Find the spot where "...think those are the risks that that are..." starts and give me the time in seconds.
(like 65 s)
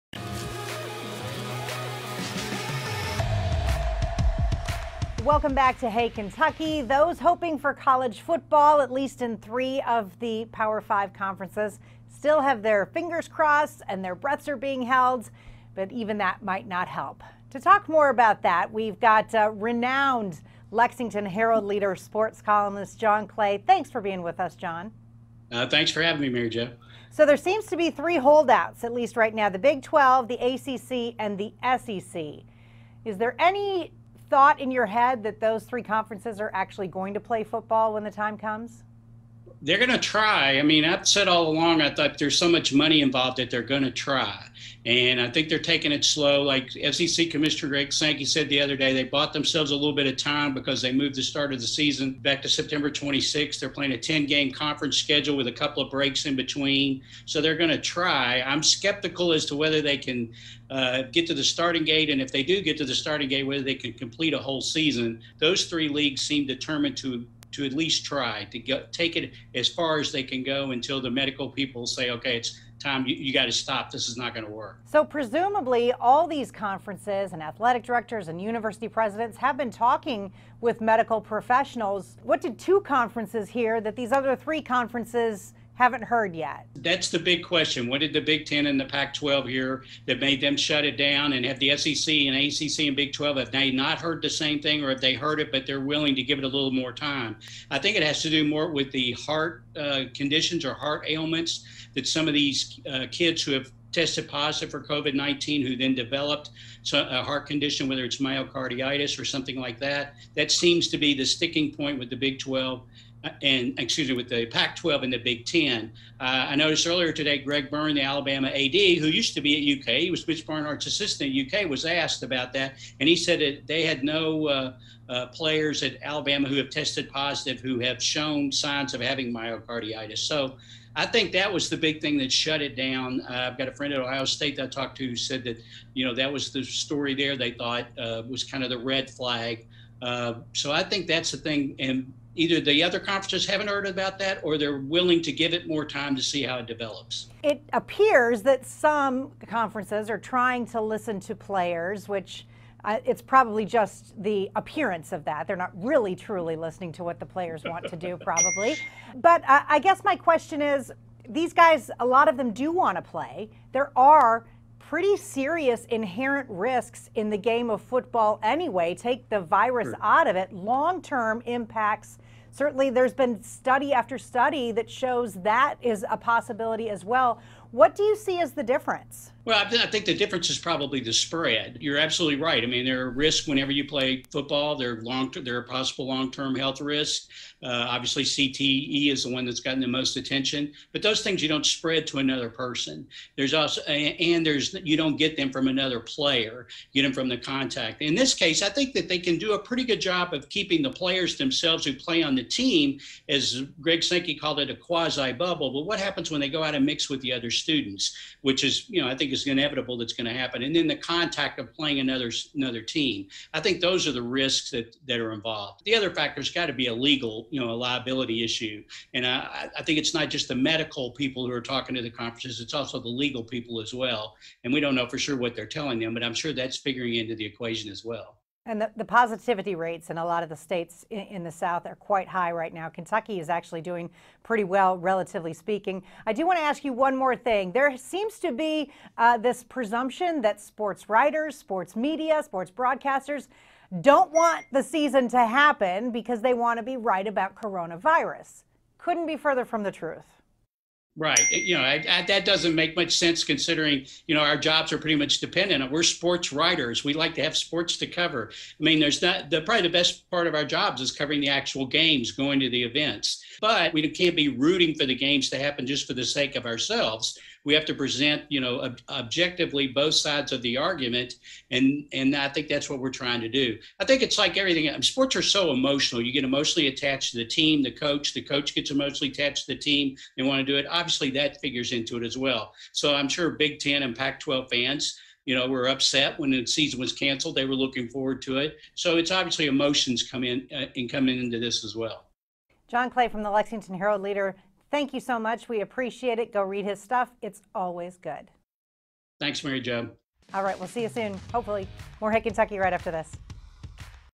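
213 s.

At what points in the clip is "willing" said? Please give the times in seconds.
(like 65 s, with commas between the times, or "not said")
95 s, 144 s.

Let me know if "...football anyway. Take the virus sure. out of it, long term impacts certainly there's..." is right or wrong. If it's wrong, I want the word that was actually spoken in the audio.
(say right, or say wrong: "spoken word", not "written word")
right.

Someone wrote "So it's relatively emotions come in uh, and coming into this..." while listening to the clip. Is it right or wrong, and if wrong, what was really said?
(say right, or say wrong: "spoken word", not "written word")
wrong: "obviously", not "relatively".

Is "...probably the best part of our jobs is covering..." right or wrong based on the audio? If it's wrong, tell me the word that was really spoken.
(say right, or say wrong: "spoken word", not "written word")
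right.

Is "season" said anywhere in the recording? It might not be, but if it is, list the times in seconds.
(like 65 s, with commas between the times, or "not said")
51 s, 64 s, 244 s, 286 s.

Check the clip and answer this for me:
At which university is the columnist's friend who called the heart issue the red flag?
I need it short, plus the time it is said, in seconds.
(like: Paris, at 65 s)
Ohio State, at 134 s.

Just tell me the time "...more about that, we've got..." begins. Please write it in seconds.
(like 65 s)
17 s.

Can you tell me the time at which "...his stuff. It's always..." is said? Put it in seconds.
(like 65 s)
296 s.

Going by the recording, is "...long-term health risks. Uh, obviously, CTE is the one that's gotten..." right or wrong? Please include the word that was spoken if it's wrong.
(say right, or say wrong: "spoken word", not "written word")
right.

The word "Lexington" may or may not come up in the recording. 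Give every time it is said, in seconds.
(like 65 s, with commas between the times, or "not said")
20 s, 293 s.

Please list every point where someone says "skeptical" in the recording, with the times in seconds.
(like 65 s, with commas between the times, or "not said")
58 s.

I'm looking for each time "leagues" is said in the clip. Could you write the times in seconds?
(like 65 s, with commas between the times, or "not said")
65 s.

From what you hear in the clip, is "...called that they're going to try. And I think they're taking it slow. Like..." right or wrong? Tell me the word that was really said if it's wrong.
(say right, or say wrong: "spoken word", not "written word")
wrong: "involved", not "called".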